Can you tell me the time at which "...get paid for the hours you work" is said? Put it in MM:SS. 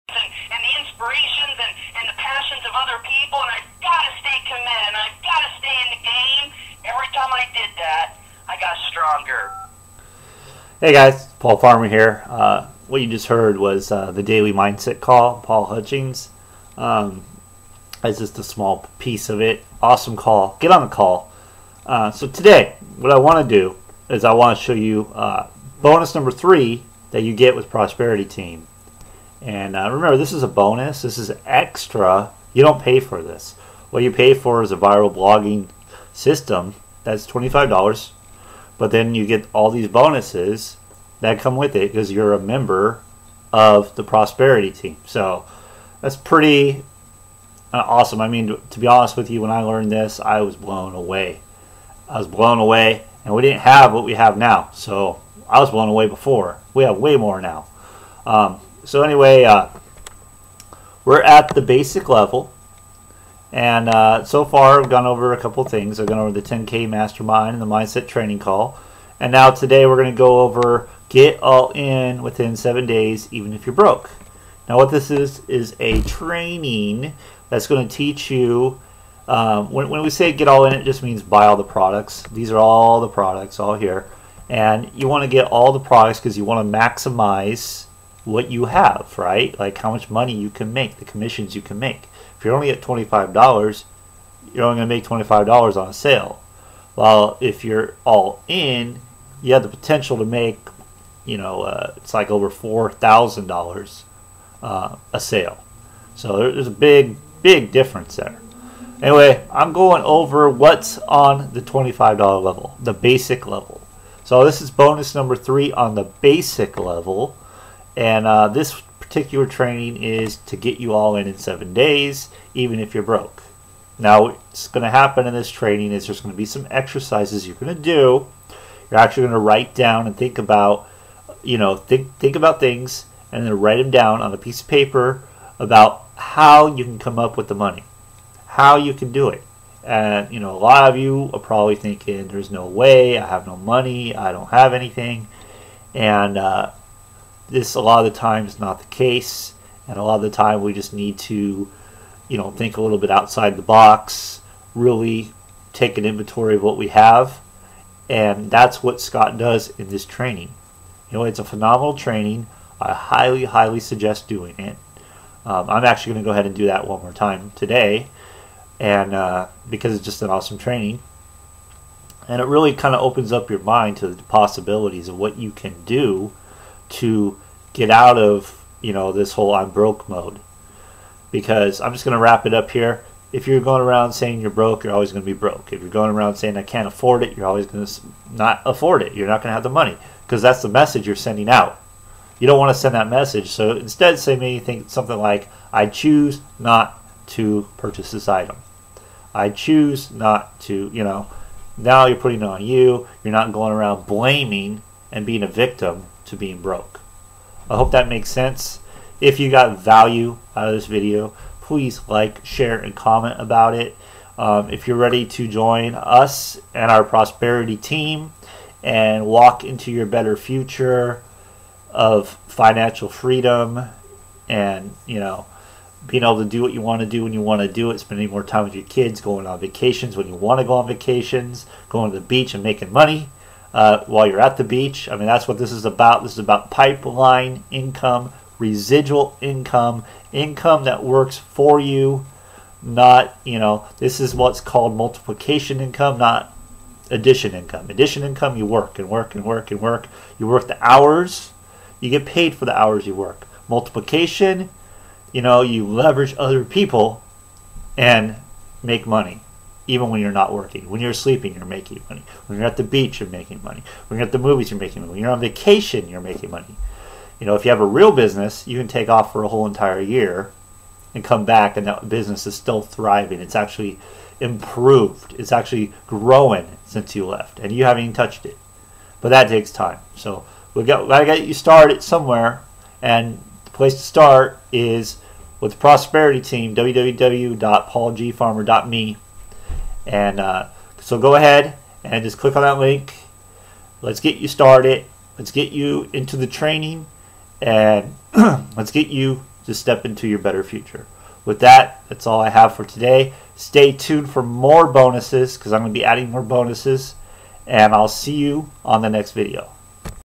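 04:12.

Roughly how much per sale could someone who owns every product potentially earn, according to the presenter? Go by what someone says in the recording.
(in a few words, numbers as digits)
over $4,000.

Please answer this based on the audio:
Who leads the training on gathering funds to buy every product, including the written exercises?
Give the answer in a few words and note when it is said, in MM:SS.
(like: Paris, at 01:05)
Scott, at 02:39.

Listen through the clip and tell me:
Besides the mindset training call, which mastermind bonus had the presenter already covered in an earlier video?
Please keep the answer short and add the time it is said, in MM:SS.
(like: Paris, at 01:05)
10K Mastermind, at 01:06.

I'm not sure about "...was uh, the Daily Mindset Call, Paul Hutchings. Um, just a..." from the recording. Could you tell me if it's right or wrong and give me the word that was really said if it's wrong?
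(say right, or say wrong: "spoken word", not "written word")
right.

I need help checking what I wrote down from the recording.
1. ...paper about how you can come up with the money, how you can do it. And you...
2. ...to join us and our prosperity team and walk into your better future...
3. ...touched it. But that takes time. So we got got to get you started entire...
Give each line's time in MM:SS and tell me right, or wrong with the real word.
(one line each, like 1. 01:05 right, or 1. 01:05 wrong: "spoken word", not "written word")
1. 02:14 right
2. 03:35 right
3. 04:38 wrong: "somewhere", not "entire".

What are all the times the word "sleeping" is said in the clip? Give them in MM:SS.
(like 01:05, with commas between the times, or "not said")
04:21.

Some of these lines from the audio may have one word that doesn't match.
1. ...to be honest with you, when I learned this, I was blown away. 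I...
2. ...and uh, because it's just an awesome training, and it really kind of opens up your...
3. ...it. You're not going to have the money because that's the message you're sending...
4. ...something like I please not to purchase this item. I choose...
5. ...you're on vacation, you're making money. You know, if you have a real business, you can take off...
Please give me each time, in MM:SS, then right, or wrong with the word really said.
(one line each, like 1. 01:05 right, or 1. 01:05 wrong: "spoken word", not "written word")
1. 00:48 right
2. 02:48 right
3. 03:09 right
4. 03:14 wrong: "choose", not "please"
5. 04:25 right.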